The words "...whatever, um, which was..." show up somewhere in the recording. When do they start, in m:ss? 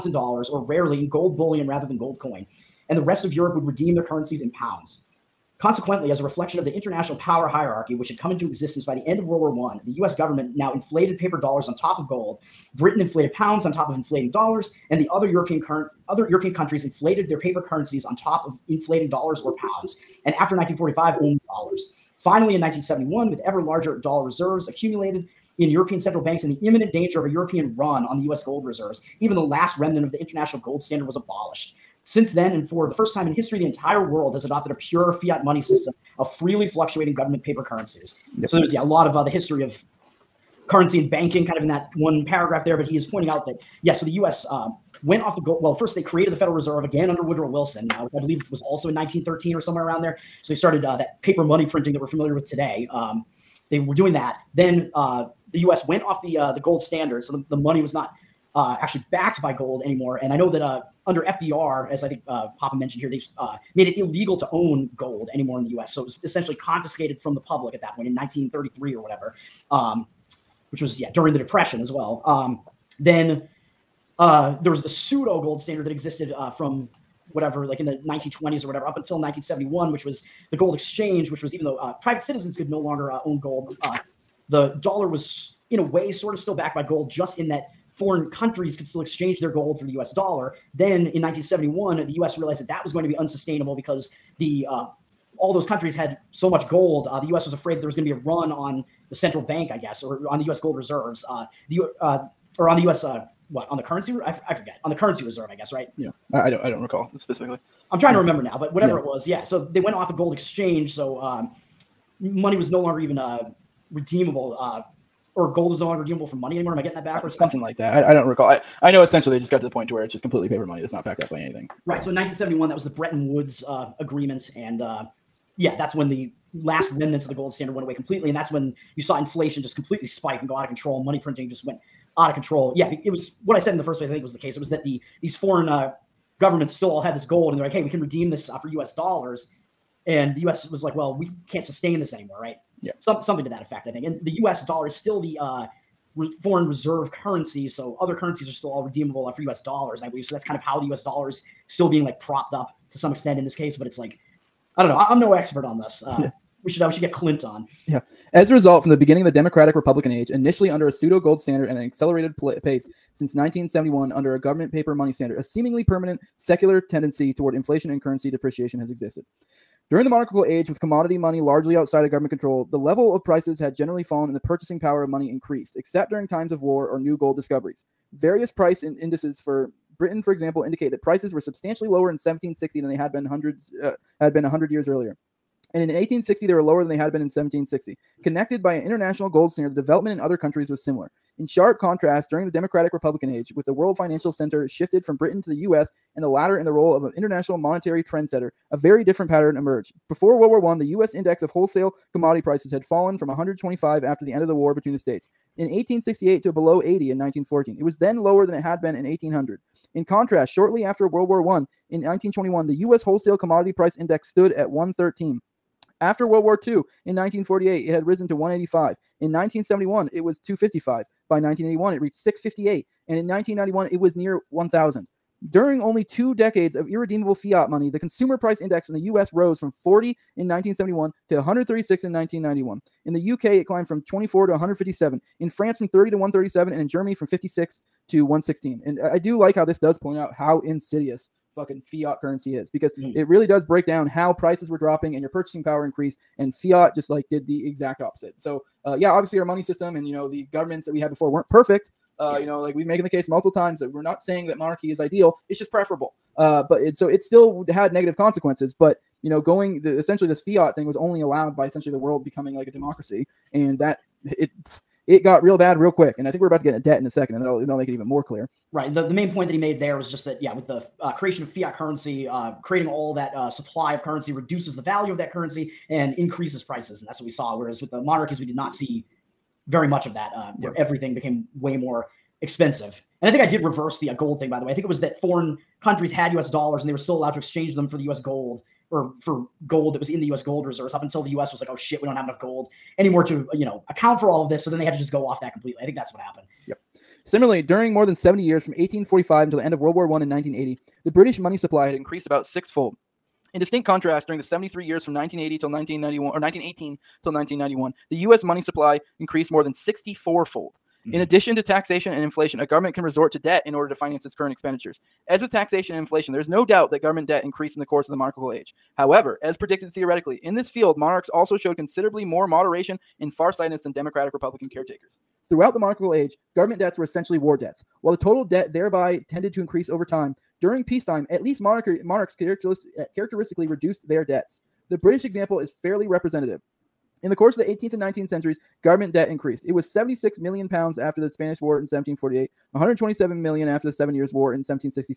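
1:09.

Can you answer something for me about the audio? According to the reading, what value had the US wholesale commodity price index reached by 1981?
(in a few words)
658.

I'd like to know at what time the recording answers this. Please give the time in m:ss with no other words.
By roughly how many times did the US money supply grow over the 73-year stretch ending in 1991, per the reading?
5:09.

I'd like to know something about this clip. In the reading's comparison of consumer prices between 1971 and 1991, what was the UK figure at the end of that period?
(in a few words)
157.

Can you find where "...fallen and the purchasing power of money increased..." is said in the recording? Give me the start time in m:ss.
2:54.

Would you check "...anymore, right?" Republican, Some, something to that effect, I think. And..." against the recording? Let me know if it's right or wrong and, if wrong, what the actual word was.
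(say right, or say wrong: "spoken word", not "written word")
wrong: "Yeah", not "Republican".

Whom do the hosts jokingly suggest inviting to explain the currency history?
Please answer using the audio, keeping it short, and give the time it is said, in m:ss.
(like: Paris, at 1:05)
Clint, at 2:37.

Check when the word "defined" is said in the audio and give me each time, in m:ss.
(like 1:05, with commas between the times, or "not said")
not said.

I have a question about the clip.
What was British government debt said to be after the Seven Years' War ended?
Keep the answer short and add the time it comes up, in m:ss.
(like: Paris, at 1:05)
127 million pounds, at 5:42.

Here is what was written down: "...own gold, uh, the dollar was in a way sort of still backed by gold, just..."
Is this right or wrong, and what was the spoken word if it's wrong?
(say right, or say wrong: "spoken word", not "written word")
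right.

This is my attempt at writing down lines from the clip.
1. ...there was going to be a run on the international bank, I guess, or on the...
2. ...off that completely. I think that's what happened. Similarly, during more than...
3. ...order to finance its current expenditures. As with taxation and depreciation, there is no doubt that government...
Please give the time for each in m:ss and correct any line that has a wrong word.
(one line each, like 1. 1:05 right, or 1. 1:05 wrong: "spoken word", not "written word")
1. 1:37 wrong: "central", not "international"
2. 4:55 right
3. 5:13 wrong: "inflation", not "depreciation".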